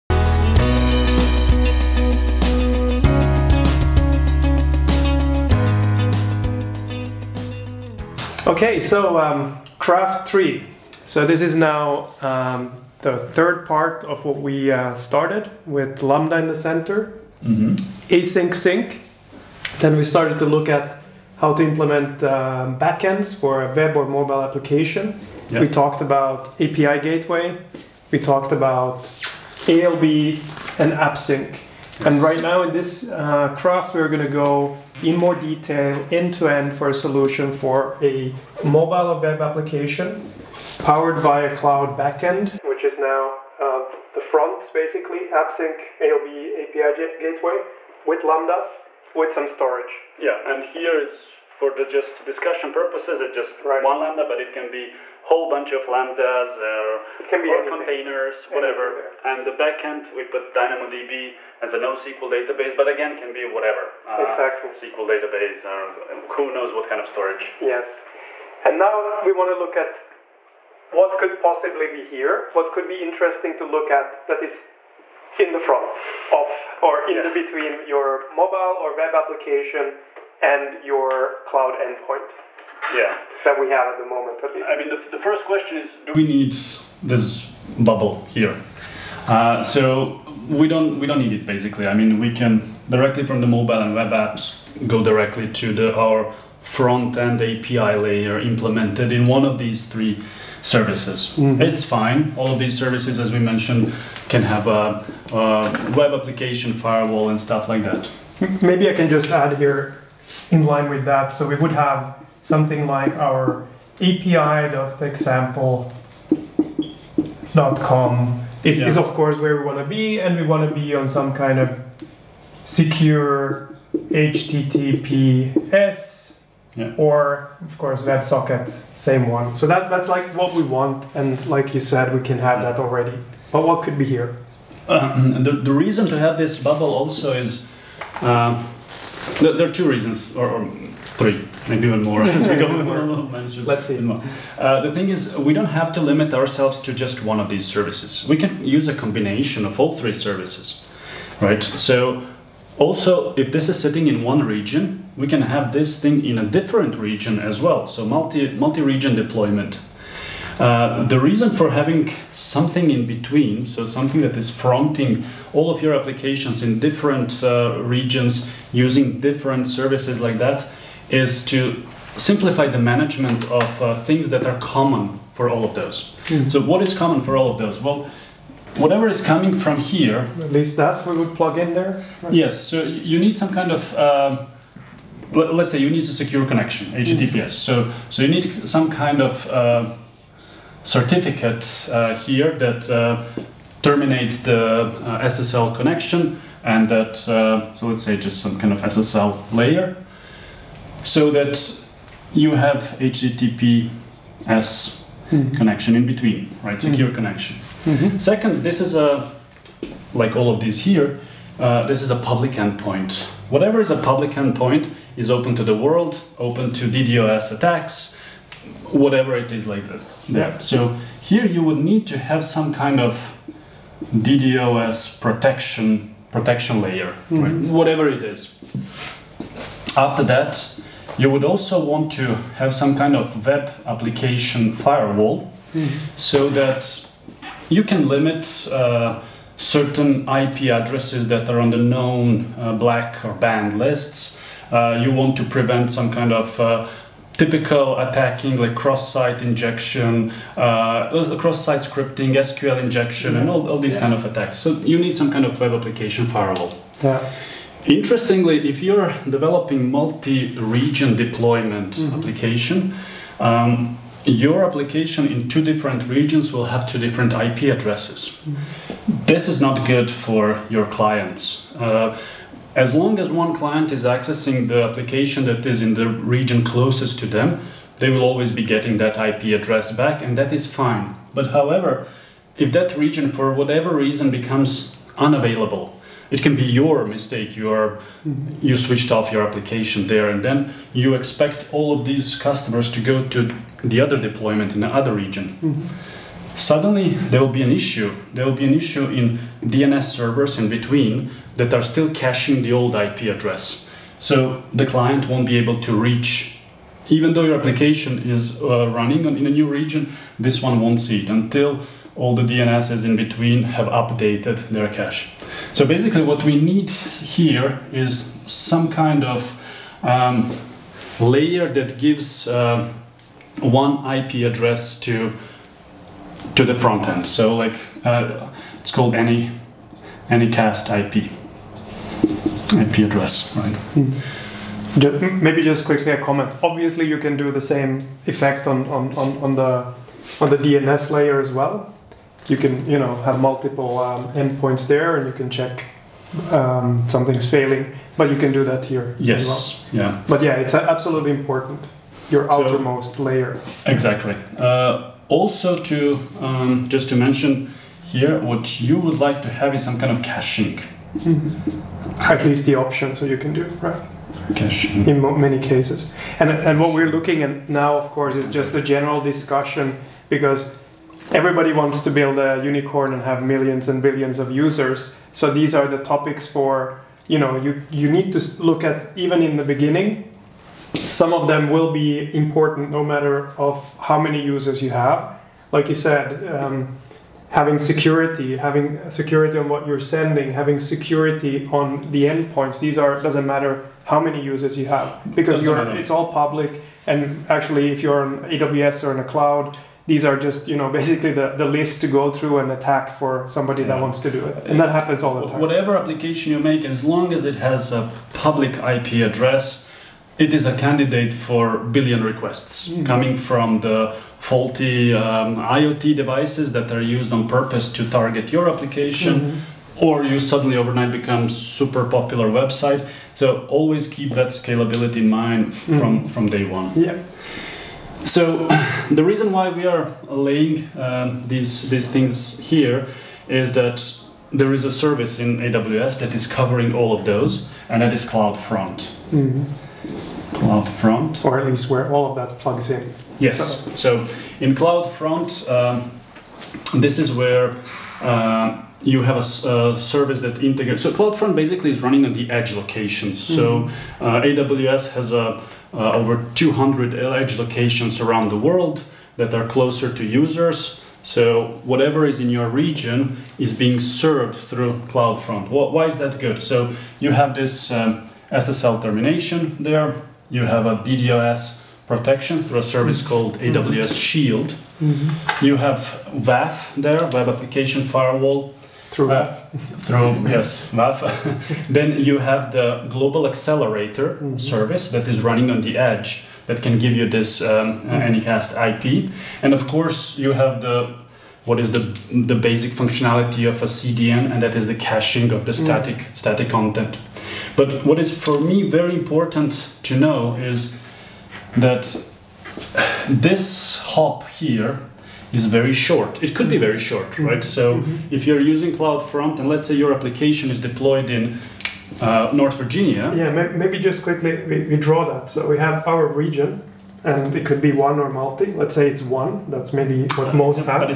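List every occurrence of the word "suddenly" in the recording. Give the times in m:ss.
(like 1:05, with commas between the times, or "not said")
4:56, 7:00.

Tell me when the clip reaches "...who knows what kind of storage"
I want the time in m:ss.
1:06.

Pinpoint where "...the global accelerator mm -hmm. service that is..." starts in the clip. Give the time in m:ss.
8:02.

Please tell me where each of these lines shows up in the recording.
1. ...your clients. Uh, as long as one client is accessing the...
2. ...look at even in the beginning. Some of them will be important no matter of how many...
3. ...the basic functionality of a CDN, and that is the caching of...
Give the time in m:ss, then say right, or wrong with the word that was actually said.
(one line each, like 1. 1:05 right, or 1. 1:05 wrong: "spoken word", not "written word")
1. 4:30 right
2. 6:18 right
3. 8:12 right.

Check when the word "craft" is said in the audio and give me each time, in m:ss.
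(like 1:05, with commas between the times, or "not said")
0:09, 0:33.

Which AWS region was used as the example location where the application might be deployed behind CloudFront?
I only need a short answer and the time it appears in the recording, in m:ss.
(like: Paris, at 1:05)
North Virginia, at 8:32.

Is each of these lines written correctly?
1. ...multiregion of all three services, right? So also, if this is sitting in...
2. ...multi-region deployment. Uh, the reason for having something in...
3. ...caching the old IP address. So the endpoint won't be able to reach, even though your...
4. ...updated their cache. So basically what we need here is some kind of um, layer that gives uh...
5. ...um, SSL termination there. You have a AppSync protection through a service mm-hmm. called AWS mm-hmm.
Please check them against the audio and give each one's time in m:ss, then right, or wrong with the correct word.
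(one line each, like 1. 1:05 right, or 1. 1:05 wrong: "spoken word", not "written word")
1. 2:28 wrong: "combination", not "multiregion"
2. 2:38 right
3. 5:02 wrong: "client", not "endpoint"
4. 5:13 right
5. 7:47 wrong: "DDoS", not "AppSync".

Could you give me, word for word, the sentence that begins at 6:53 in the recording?
coming from the faulty um, iot devices that are used on purpose to target your application mm-hmm.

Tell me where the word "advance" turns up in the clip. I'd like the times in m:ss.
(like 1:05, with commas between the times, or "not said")
not said.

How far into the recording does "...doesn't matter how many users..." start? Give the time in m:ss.
6:33.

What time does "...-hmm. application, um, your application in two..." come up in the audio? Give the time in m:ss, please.
4:22.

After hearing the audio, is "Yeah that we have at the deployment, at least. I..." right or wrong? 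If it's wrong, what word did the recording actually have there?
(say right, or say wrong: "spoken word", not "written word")
wrong: "moment", not "deployment".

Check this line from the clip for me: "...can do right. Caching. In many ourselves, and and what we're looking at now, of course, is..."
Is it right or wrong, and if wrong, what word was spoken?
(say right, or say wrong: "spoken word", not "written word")
wrong: "cases", not "ourselves".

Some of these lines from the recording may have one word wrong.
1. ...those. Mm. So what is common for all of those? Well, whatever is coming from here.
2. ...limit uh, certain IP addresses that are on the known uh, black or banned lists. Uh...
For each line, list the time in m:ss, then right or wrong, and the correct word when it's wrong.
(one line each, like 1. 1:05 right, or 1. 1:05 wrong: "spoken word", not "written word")
1. 2:55 right
2. 3:58 right.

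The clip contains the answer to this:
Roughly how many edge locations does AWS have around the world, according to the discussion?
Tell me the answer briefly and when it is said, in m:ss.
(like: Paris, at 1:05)
over 200, at 7:36.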